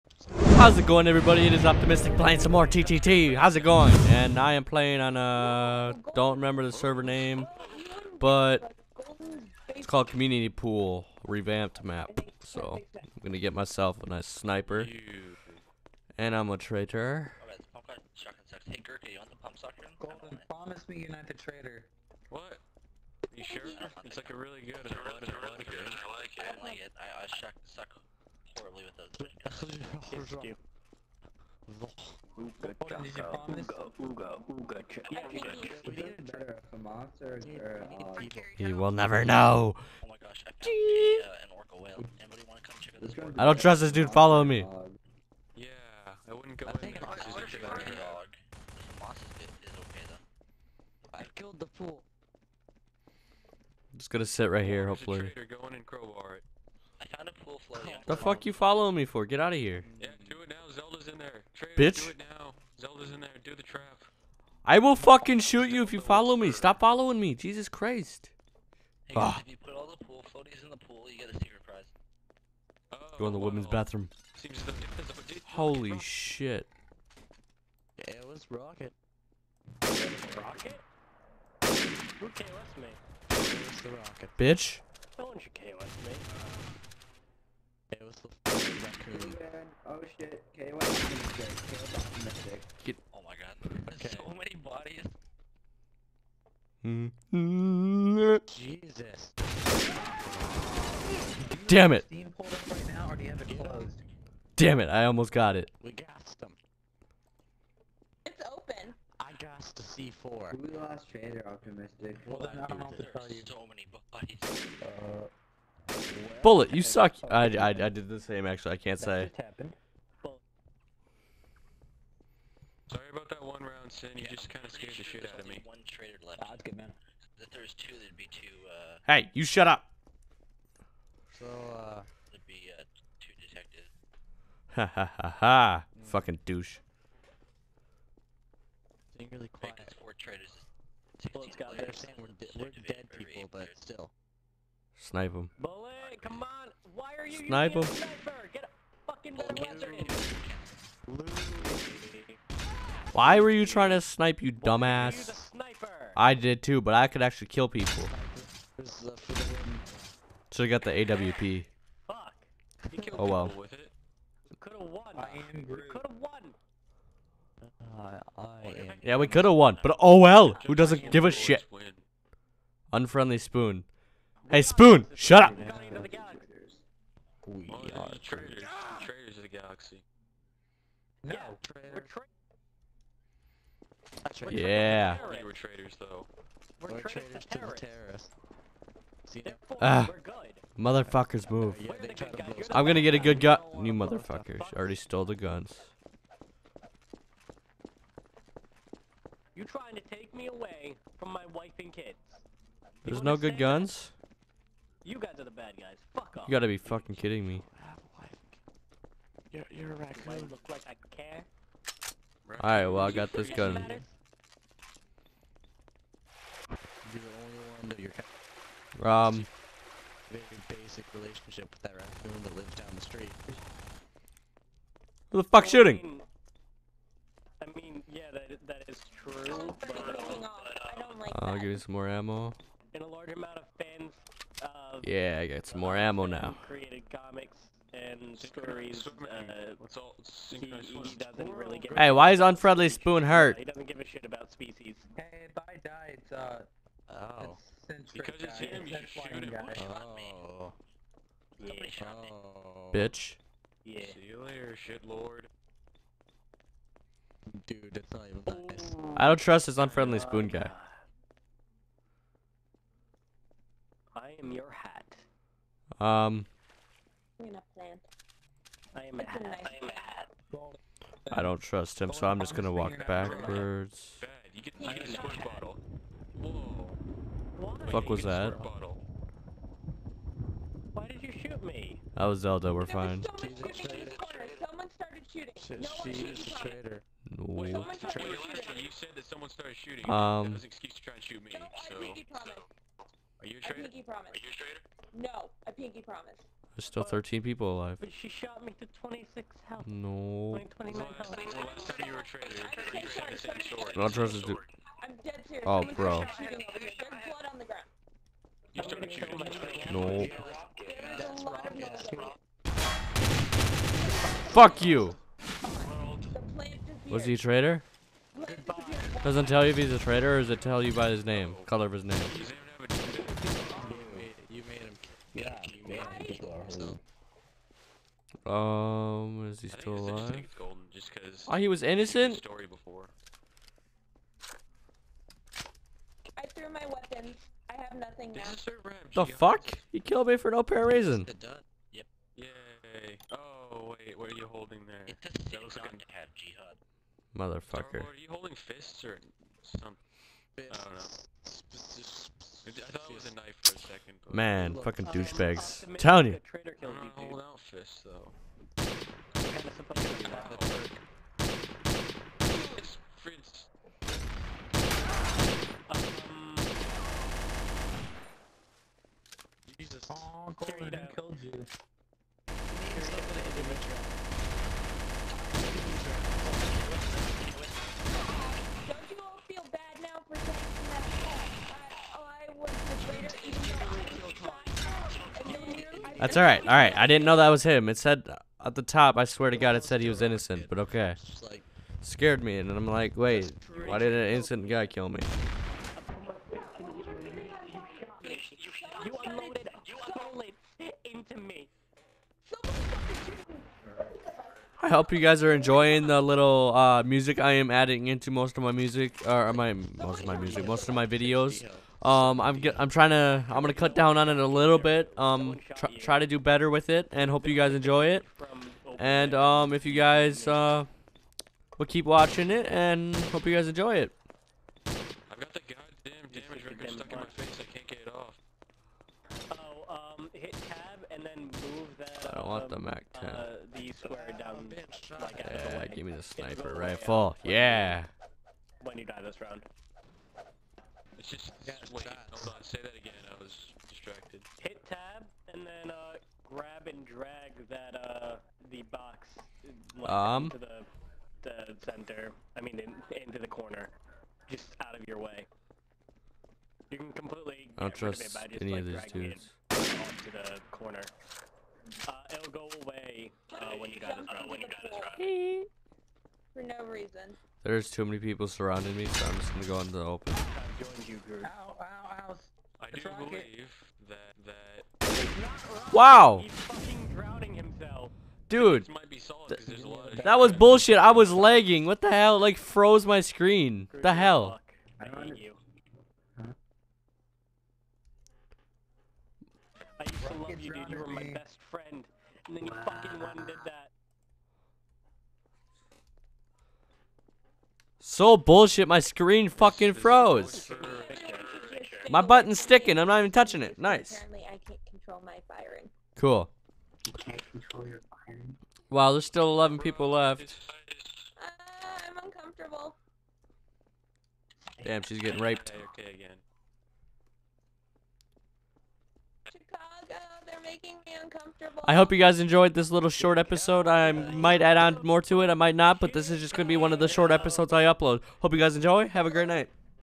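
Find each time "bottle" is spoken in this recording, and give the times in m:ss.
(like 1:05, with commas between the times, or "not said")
not said.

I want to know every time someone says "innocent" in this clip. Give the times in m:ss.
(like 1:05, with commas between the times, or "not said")
5:31, 6:30, 6:34.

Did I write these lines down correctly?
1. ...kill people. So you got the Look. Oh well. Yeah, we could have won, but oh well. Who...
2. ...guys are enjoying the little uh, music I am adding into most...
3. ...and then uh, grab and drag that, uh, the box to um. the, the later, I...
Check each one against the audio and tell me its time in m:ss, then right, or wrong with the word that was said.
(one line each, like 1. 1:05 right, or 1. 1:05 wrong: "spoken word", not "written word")
1. 2:37 wrong: "AWP", not "Look"
2. 6:45 right
3. 7:25 wrong: "center", not "later".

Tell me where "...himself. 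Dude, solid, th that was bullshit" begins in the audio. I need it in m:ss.
7:57.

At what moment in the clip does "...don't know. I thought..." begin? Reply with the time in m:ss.
5:50.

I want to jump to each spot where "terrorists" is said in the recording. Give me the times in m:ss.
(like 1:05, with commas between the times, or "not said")
3:07.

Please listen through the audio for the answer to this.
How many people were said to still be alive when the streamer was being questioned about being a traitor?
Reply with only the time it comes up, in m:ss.
4:57.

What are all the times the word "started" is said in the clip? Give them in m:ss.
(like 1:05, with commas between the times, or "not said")
4:49, 5:08.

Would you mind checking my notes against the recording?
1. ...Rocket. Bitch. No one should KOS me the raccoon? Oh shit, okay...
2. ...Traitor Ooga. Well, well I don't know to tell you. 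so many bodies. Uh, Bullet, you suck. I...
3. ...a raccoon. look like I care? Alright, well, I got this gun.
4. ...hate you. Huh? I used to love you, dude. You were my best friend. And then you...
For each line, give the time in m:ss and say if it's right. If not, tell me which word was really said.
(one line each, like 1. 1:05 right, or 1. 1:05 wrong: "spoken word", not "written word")
1. 1:23 right
2. 1:51 wrong: "Optimistic", not "Ooga"
3. 3:29 right
4. 8:05 right.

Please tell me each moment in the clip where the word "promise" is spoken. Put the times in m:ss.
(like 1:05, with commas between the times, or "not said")
0:20, 4:56.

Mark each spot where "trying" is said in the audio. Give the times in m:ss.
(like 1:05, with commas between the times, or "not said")
2:33, 3:19, 6:52.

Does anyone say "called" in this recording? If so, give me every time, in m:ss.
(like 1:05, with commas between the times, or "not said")
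0:09.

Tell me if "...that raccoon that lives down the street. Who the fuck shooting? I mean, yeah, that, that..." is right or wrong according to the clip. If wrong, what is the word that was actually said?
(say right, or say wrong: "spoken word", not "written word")
right.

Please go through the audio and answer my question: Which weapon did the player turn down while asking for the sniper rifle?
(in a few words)
Mac 10.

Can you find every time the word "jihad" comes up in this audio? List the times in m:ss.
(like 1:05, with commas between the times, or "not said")
5:46.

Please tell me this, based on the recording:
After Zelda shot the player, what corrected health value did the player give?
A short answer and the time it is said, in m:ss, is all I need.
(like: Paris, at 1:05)
29, at 5:00.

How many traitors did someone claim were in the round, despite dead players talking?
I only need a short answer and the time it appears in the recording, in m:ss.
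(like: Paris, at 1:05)
4, at 2:19.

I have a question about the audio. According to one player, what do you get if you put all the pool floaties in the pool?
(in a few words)
A secret prize.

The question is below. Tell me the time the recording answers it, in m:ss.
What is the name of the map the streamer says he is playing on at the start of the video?
0:10.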